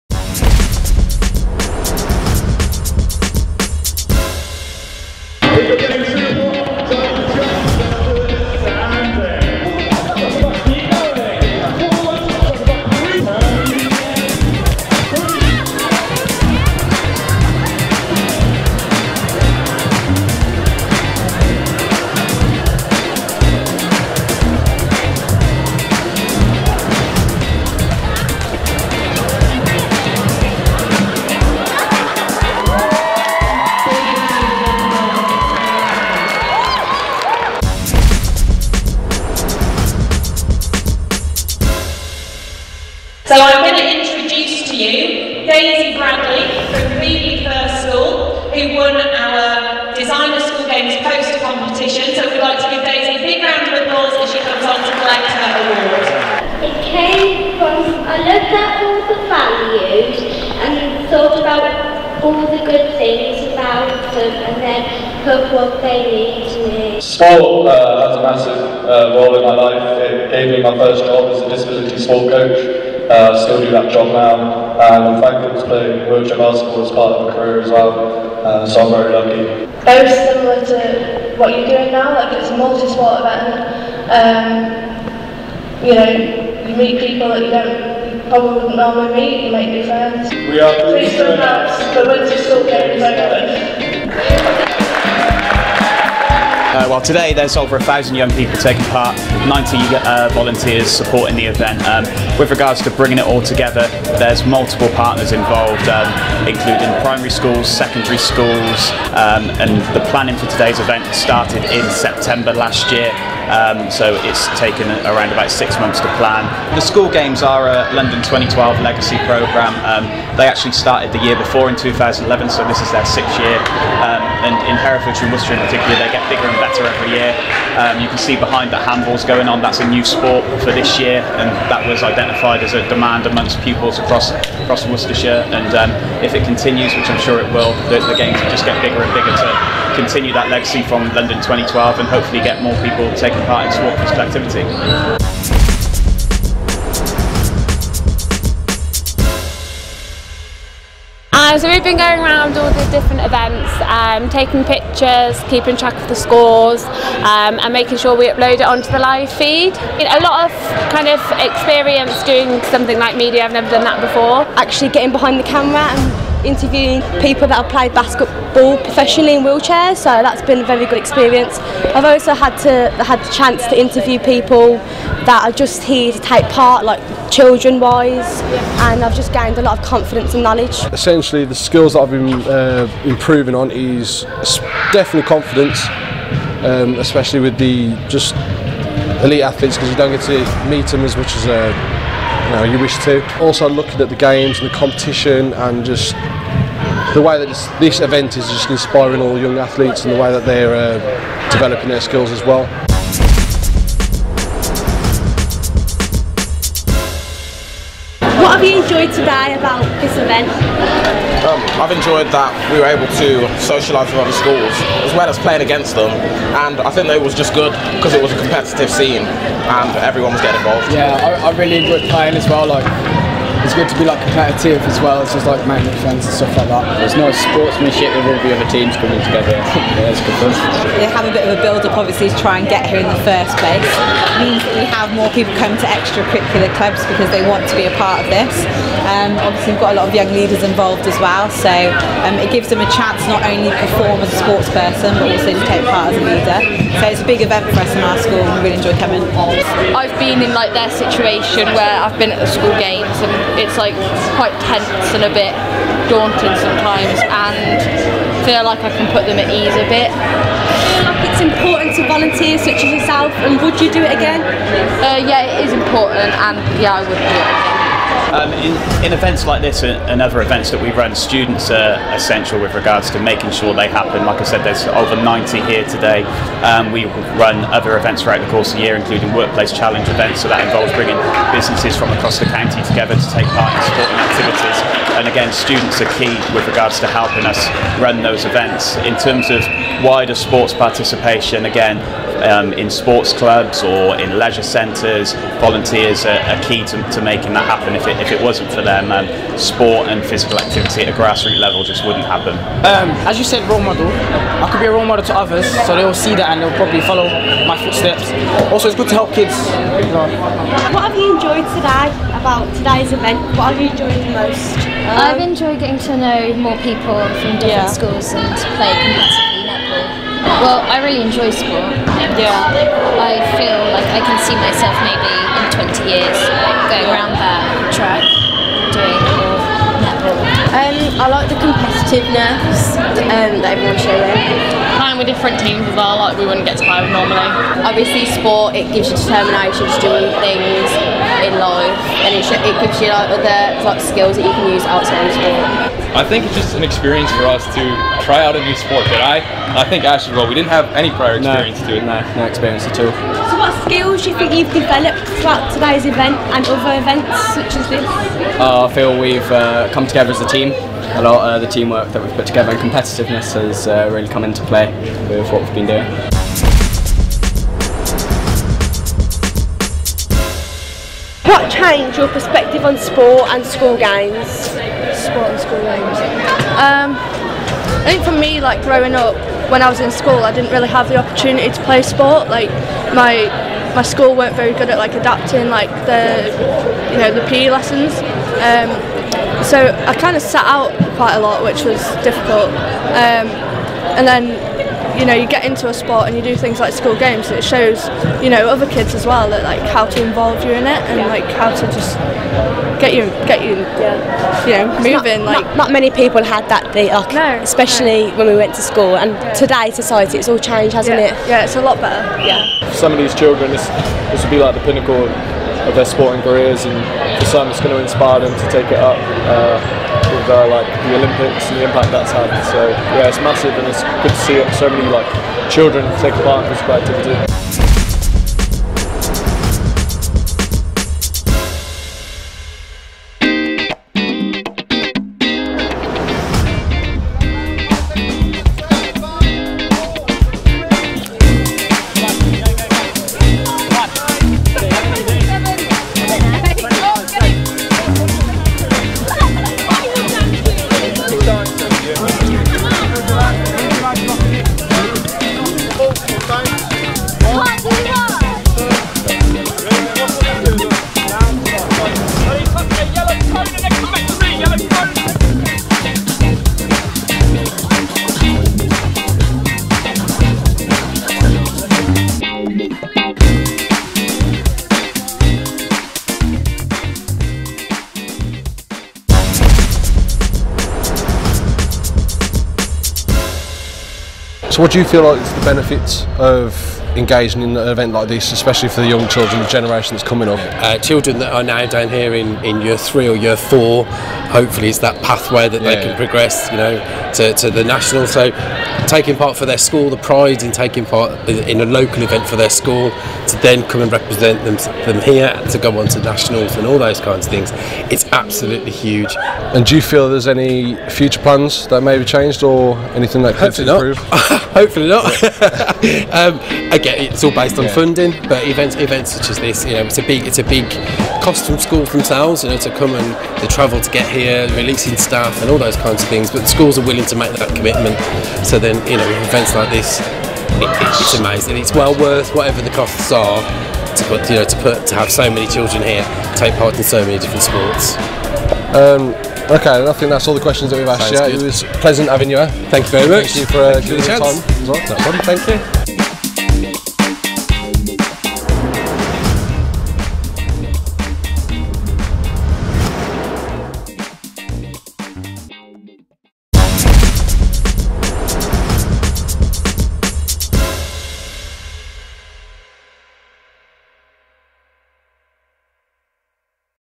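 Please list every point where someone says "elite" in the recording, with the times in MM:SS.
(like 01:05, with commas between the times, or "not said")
03:09.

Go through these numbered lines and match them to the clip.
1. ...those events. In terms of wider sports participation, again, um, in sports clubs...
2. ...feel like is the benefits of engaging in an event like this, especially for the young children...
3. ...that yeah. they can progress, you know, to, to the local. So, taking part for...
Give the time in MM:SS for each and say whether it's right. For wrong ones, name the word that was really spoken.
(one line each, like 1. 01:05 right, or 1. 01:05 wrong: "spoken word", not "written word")
1. 04:48 right
2. 08:05 right
3. 08:15 wrong: "national", not "local".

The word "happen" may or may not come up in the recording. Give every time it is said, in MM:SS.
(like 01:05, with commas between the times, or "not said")
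04:33, 04:57, 05:02.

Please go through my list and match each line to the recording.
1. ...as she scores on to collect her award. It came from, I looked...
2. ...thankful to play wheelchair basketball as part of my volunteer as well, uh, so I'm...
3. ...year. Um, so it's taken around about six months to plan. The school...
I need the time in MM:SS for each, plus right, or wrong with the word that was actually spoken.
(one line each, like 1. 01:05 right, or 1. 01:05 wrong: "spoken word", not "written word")
1. 00:54 wrong: "comes", not "scores"
2. 01:15 wrong: "career", not "volunteer"
3. 01:52 right.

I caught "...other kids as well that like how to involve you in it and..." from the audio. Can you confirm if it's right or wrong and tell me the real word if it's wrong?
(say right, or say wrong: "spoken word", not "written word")
right.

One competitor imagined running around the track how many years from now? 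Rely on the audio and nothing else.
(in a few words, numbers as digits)
20 years.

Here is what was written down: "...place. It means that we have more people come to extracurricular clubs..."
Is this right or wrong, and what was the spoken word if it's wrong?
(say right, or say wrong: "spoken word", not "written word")
right.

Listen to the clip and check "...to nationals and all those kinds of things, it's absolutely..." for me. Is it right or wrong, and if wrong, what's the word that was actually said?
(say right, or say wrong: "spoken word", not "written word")
right.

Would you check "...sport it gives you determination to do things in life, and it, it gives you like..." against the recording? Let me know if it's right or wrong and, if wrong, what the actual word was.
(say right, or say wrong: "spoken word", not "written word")
right.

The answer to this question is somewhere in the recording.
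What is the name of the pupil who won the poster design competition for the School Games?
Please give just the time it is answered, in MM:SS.
00:45.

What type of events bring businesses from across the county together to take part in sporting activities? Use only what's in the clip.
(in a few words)
Workplace challenge events.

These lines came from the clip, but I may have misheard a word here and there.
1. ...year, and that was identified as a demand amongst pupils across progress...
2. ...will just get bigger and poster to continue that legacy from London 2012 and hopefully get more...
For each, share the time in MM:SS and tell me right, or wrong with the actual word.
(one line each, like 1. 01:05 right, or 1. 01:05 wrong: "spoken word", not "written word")
1. 02:10 wrong: "across", not "progress"
2. 02:18 wrong: "bigger", not "poster".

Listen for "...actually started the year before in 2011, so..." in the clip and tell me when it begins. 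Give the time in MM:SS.
02:00.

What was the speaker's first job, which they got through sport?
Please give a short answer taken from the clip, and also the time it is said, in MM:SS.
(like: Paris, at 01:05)
Disability sport coach, at 01:11.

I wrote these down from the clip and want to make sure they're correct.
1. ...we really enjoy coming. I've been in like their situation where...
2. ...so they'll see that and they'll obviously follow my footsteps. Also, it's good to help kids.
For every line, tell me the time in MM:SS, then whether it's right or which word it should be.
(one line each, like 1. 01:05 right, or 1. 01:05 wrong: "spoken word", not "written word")
1. 04:08 right
2. 05:05 wrong: "probably", not "obviously".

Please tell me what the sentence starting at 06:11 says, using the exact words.
What changed your perspective on sport and school games?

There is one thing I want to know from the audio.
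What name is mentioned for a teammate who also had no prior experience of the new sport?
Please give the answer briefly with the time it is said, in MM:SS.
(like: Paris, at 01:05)
Ash, at 05:50.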